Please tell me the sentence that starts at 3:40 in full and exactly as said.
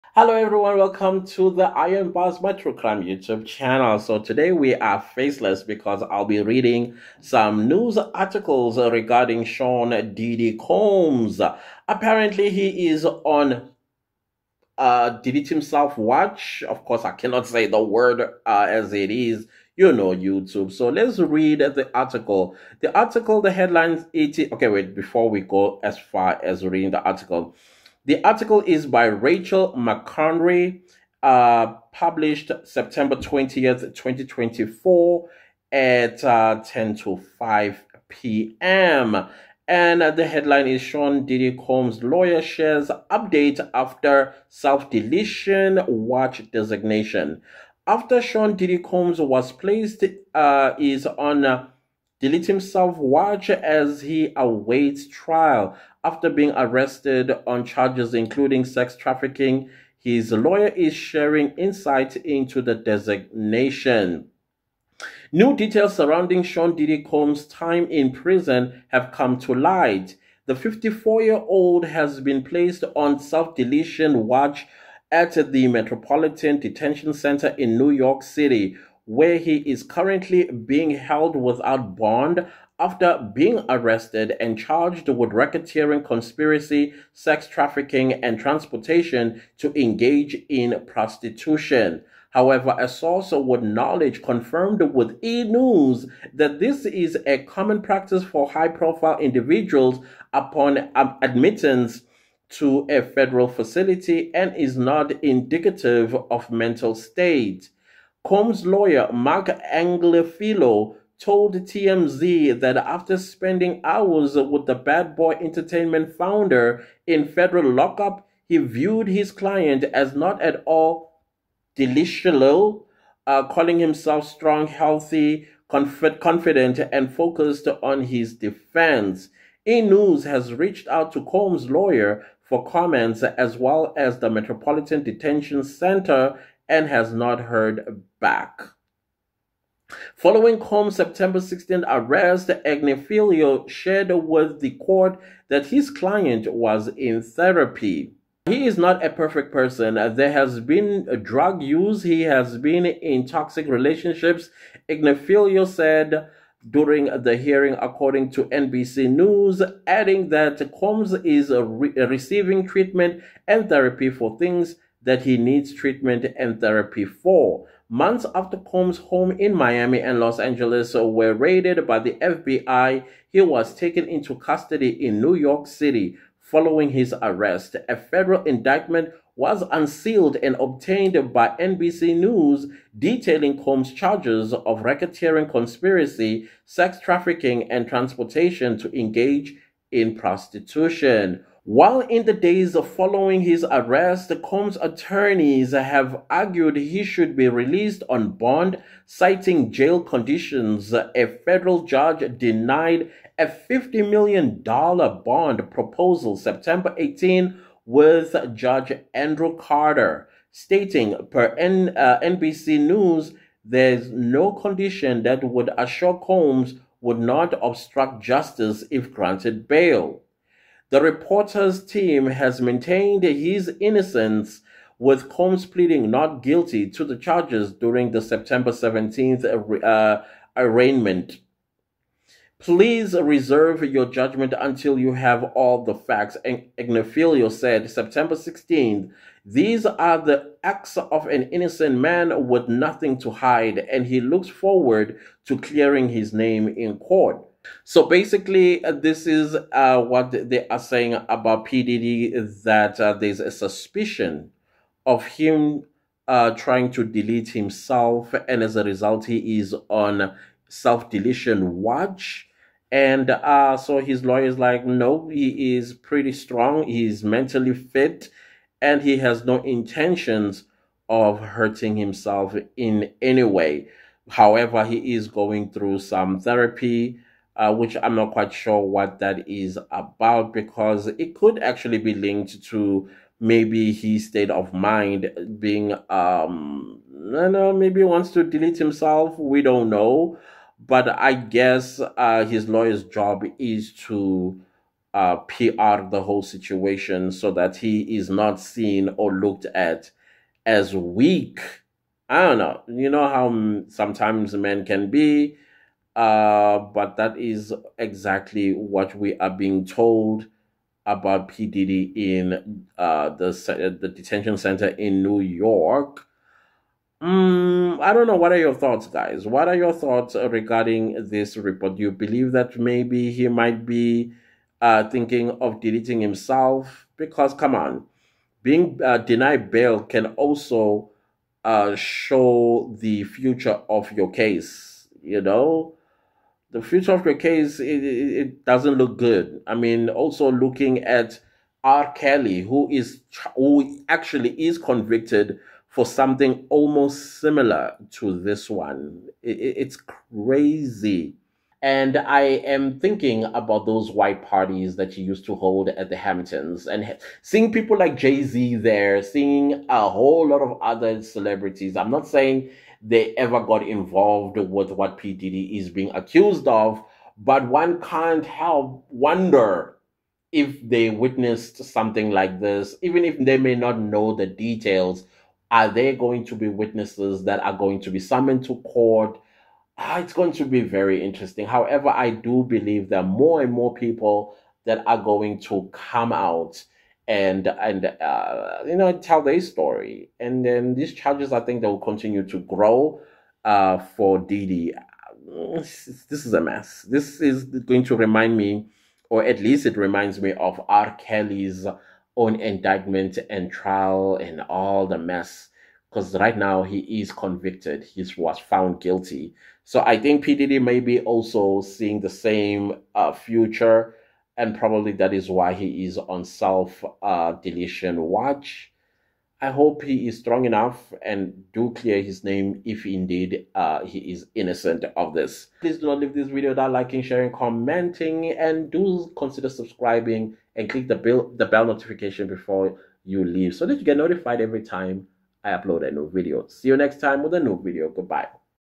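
The reporter's team has maintained his innocence, with Combs pleading not guilty to the charges during the September 17th uh, uh, arraignment.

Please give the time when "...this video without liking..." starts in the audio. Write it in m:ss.
7:06.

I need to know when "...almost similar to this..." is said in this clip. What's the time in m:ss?
5:46.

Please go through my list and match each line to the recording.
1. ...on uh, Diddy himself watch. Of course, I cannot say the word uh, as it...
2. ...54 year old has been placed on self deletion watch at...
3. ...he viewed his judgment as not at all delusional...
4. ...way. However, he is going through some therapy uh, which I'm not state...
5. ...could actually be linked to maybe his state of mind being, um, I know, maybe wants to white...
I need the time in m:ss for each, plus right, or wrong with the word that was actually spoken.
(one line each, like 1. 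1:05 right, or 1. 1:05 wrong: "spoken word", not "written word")
1. 0:13 right
2. 1:10 right
3. 1:58 wrong: "client", not "judgment"
4. 4:33 wrong: "quite", not "state"
5. 4:41 wrong: "delete", not "white".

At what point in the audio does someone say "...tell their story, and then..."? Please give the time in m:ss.
6:29.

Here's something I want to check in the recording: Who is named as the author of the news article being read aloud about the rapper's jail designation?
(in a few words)
Rachel McConry.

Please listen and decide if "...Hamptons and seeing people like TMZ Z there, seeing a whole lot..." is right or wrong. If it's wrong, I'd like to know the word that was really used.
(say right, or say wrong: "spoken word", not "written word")
wrong: "Jay", not "TMZ".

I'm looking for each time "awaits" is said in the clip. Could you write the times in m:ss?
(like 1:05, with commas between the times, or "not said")
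0:54.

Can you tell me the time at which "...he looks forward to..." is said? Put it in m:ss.
4:04.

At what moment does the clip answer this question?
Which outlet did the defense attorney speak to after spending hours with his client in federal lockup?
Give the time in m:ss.
1:51.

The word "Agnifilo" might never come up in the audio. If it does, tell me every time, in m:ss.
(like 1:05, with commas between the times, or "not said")
1:49, 2:22, 2:34, 3:56.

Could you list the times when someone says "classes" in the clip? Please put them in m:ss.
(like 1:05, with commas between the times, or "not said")
not said.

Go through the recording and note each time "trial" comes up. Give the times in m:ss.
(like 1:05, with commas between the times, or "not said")
0:55, 6:43.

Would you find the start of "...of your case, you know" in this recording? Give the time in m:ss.
5:33.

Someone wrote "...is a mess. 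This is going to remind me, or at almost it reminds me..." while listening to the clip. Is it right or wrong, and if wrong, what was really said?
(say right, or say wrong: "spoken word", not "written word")
wrong: "least", not "almost".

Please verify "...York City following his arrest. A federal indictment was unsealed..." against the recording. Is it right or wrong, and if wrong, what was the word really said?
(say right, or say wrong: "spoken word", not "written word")
right.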